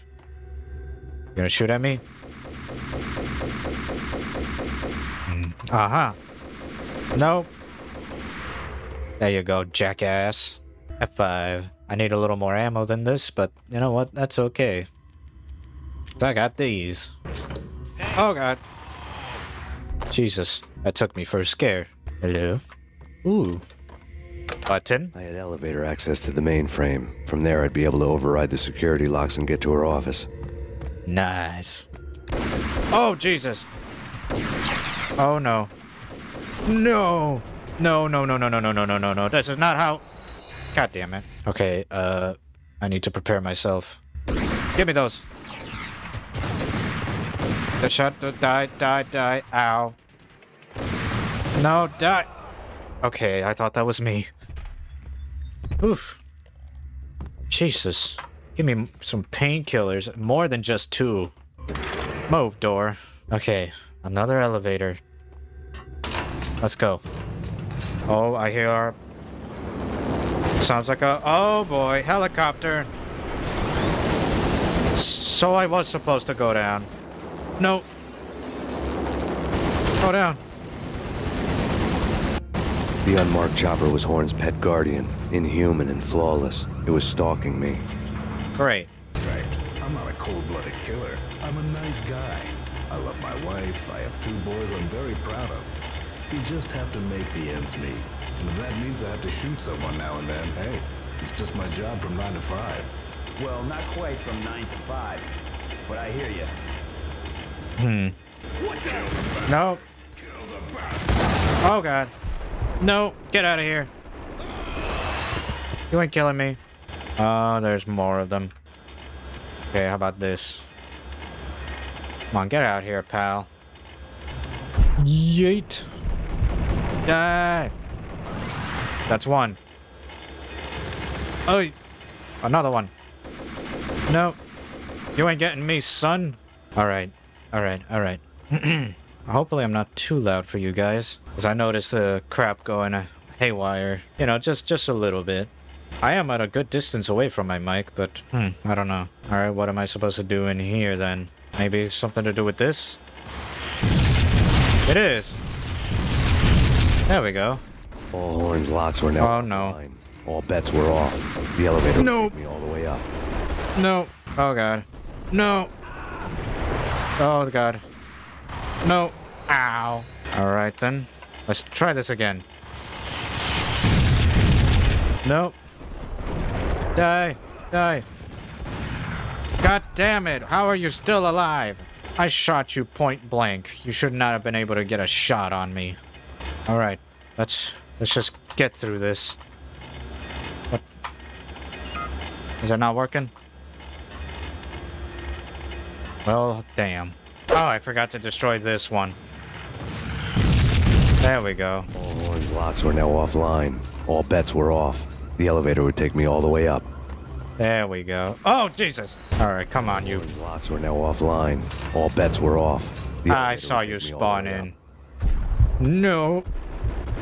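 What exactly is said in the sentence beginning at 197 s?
Oh, I forgot to destroy this one.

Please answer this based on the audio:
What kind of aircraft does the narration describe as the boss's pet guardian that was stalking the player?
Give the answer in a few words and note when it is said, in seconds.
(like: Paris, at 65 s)
unmarked chopper, at 83 s.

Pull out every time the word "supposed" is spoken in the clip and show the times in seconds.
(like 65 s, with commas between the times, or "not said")
75 s, 149 s.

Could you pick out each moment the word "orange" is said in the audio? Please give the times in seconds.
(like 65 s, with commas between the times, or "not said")
202 s, 210 s.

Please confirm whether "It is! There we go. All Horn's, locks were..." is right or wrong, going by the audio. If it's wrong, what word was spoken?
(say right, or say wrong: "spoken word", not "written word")
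right.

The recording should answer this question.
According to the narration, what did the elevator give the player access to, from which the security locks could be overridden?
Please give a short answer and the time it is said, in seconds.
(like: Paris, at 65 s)
the mainframe, at 26 s.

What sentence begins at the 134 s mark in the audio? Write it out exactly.
No, you ain't getting me, son.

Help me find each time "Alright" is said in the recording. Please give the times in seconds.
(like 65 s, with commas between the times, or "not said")
149 s, 170 s, 186 s.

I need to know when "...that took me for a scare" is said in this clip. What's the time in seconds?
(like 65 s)
20 s.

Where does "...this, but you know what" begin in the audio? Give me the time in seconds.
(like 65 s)
13 s.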